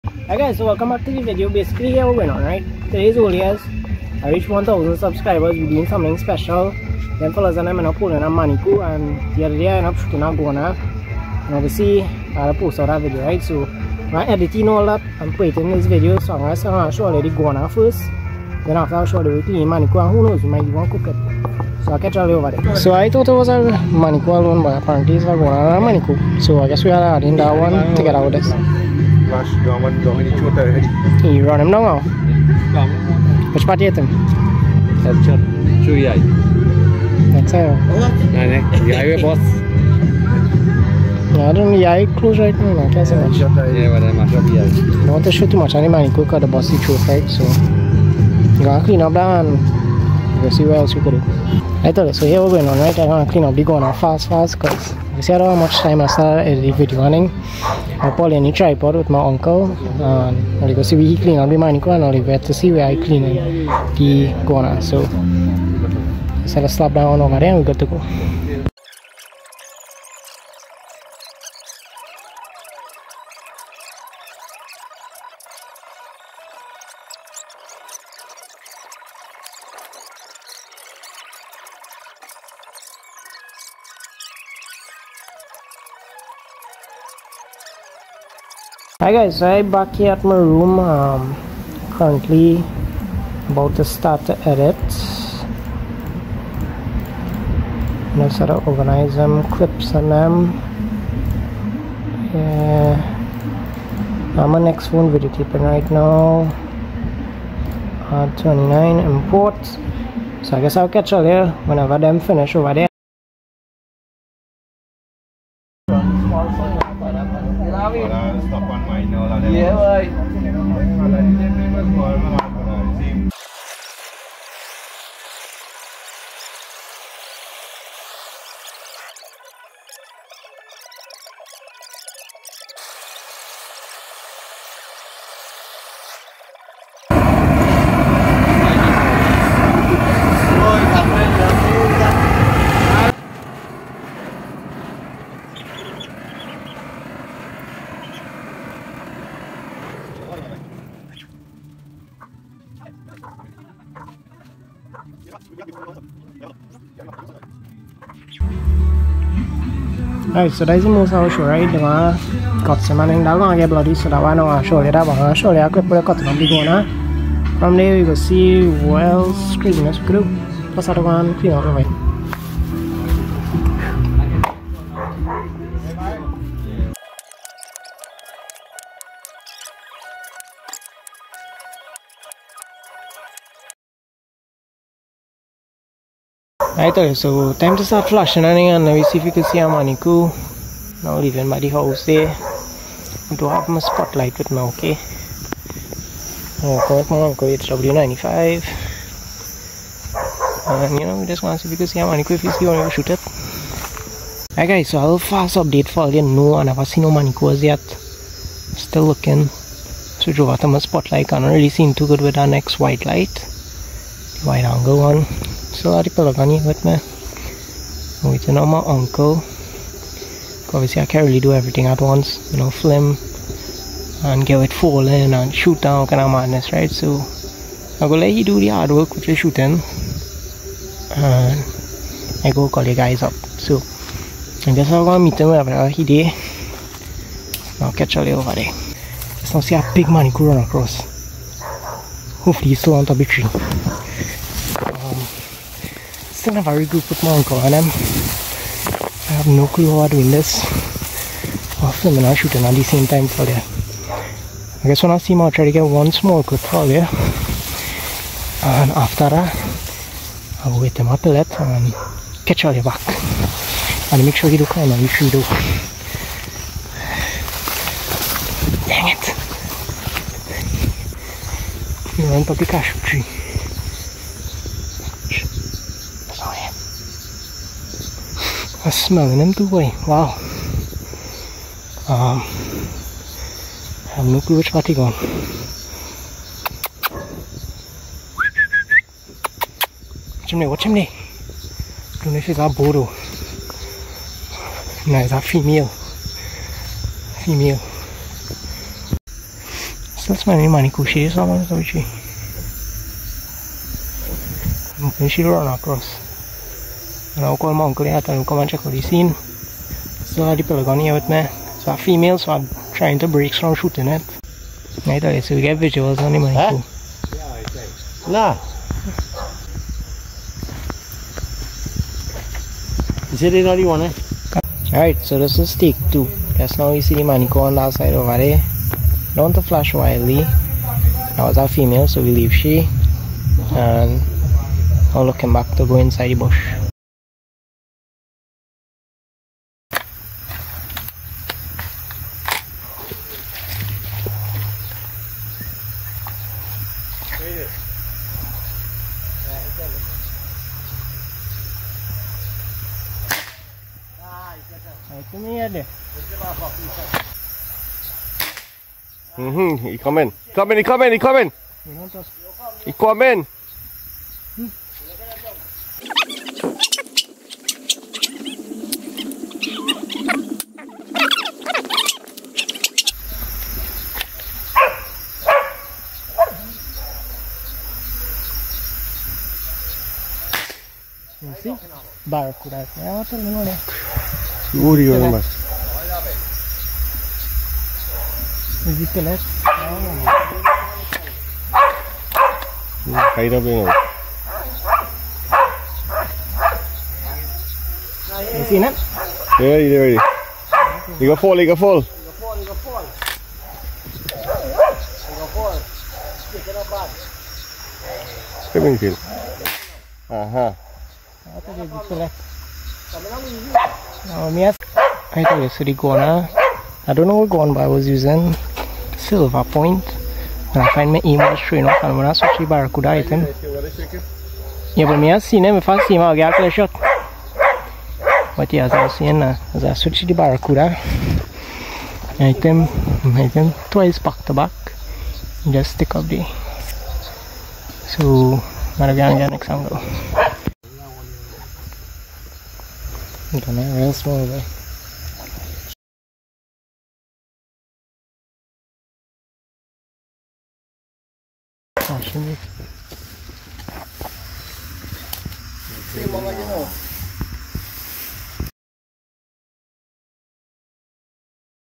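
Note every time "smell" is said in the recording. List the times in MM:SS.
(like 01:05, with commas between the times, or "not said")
04:38.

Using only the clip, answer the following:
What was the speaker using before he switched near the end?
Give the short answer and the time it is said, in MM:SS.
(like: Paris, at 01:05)
silver point, at 06:59.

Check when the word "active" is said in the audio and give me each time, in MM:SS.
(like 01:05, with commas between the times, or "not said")
not said.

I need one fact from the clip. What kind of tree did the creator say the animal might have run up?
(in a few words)
cashew tree.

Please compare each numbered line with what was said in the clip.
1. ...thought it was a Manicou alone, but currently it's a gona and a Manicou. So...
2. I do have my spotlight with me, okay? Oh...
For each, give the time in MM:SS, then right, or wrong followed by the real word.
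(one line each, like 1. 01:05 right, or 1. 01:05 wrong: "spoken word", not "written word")
1. 00:23 wrong: "apparently", not "currently"
2. 03:12 right.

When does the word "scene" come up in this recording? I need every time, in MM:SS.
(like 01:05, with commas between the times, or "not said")
05:09.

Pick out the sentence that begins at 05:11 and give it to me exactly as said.
So female, so I'm trying to break from shooting it.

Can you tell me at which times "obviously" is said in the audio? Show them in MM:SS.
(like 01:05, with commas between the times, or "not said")
00:11, 03:40.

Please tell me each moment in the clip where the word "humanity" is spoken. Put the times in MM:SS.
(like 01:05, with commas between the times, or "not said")
not said.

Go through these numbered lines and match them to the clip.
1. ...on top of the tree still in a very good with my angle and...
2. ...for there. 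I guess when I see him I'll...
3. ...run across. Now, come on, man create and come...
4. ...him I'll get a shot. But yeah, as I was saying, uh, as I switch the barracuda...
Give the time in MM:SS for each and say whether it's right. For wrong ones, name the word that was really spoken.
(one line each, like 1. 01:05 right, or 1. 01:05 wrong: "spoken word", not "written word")
1. 04:02 wrong: "uncle", not "angle"
2. 04:13 right
3. 05:05 right
4. 07:06 right.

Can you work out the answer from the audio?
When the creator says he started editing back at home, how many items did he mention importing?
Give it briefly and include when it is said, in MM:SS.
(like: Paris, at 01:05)
29, at 01:48.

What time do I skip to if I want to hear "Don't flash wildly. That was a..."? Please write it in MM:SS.
05:29.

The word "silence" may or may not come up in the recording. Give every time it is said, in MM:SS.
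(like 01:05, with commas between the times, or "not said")
not said.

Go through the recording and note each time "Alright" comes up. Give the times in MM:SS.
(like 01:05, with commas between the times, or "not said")
03:06, 03:24, 05:24.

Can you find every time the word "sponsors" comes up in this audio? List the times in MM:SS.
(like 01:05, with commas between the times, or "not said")
not said.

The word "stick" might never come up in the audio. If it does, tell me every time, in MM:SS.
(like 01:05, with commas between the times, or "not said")
07:15.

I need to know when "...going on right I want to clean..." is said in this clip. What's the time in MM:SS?
00:52.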